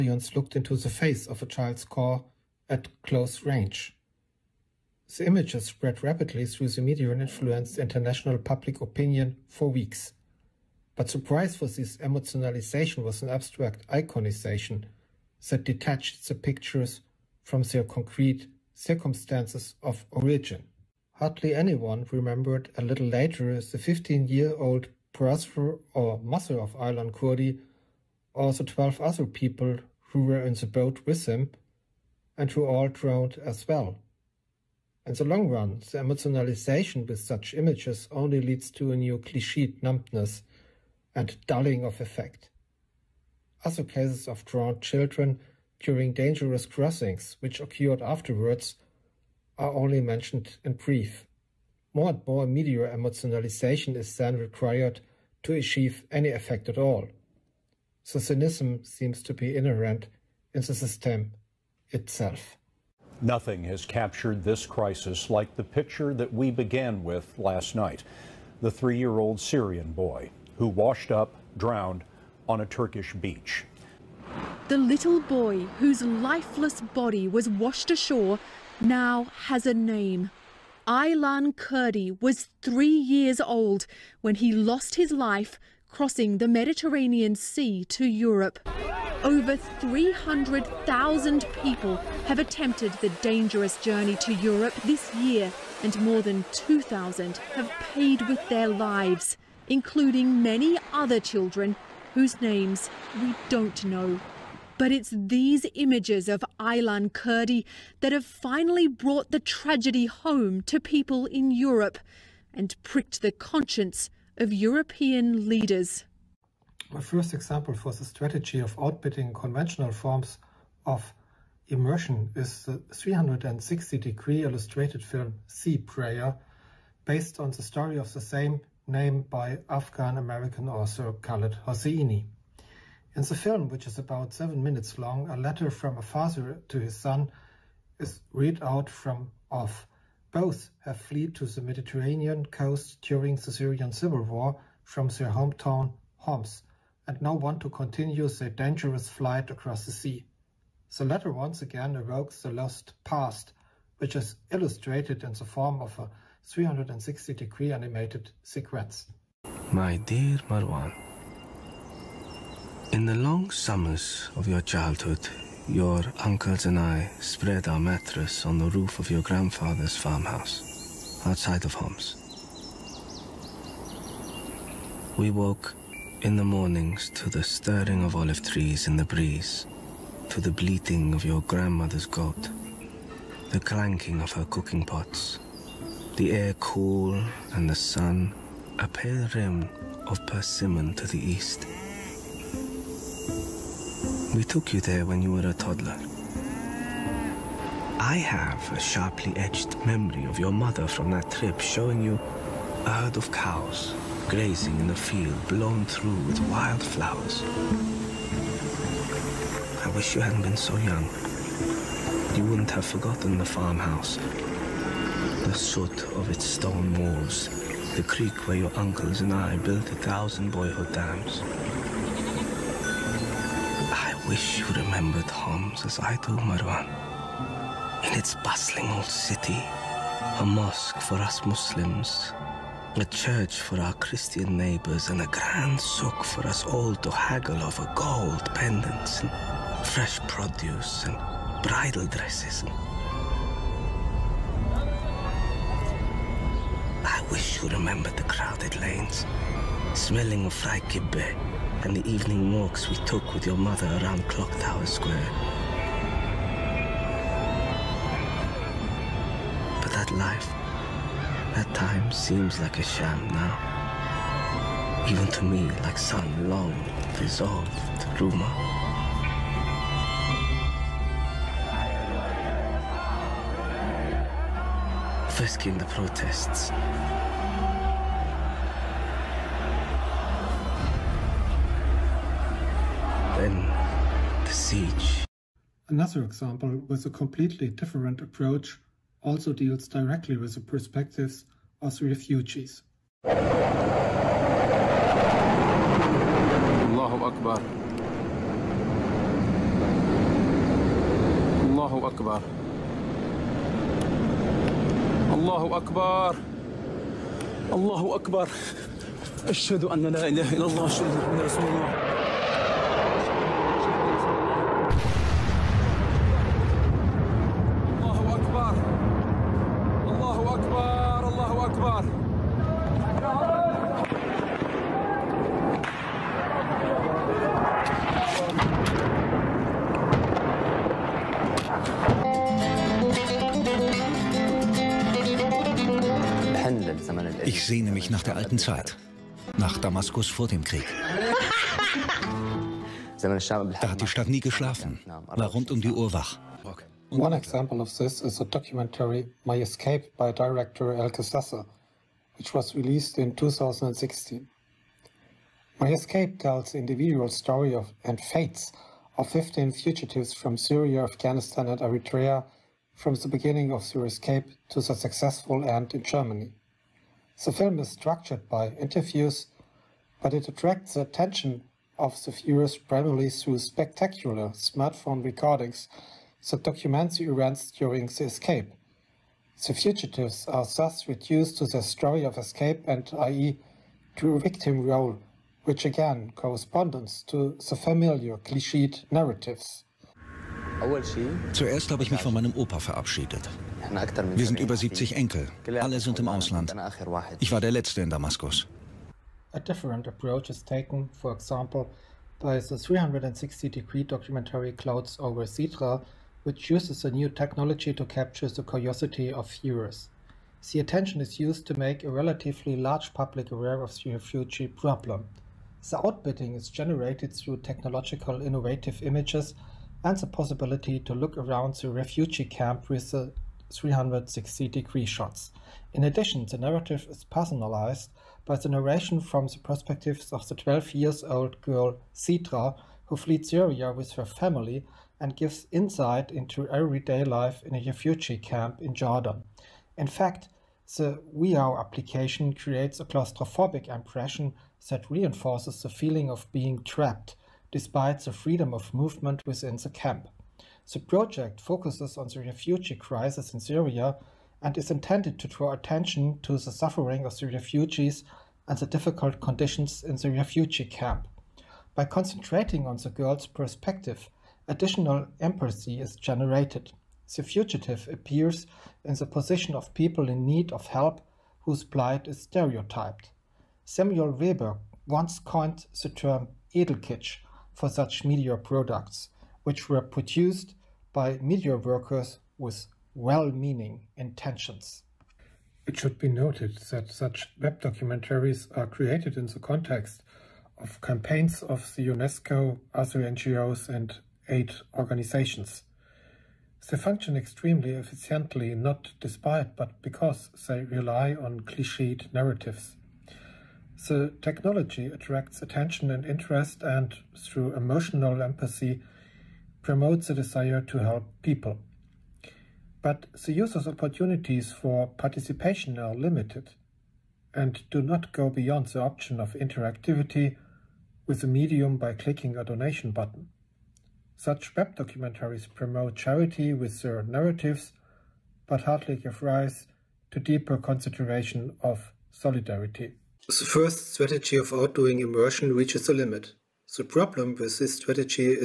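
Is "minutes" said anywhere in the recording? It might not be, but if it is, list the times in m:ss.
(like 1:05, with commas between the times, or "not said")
2:14.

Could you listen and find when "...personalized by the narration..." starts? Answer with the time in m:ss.
7:07.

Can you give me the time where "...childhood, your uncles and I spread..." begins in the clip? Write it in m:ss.
2:44.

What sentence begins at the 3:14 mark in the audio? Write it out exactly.
We took you there when you were a toddler.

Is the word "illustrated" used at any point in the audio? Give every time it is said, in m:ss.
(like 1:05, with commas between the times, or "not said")
2:04, 2:34.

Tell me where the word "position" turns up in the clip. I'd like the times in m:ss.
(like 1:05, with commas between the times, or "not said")
7:49.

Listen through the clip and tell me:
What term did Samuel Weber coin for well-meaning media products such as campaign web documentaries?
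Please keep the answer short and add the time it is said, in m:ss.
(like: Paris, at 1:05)
Edelkitsch, at 7:56.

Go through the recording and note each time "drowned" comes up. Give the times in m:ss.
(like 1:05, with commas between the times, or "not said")
0:32, 0:44, 1:11.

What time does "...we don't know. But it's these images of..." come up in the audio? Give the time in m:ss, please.
1:43.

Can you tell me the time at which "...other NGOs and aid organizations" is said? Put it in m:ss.
8:12.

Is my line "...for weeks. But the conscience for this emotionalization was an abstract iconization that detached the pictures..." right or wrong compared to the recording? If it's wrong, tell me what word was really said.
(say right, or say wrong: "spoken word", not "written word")
wrong: "price", not "conscience".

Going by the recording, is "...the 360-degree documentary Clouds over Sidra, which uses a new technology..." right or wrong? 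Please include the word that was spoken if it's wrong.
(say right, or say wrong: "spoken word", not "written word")
right.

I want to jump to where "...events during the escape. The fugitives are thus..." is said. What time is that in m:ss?
6:17.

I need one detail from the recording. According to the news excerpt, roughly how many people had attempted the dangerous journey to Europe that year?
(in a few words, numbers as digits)
300,000.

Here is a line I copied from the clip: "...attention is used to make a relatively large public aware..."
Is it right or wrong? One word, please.
right.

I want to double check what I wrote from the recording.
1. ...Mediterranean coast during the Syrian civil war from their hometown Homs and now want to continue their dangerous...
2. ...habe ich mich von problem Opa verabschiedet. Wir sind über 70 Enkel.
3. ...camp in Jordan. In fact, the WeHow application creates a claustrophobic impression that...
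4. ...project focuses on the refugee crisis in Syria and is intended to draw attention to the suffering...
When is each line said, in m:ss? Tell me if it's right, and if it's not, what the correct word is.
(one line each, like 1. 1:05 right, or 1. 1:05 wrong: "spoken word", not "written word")
1. 2:21 right
2. 6:31 wrong: "meinem", not "problem"
3. 7:18 right
4. 7:31 right.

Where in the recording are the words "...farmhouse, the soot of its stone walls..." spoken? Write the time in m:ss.
3:33.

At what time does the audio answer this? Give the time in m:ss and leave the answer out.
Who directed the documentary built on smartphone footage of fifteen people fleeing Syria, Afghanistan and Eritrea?
5:50.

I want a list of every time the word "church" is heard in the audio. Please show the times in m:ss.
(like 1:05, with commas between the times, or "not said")
3:53.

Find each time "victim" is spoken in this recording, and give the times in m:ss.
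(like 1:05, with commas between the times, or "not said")
6:24.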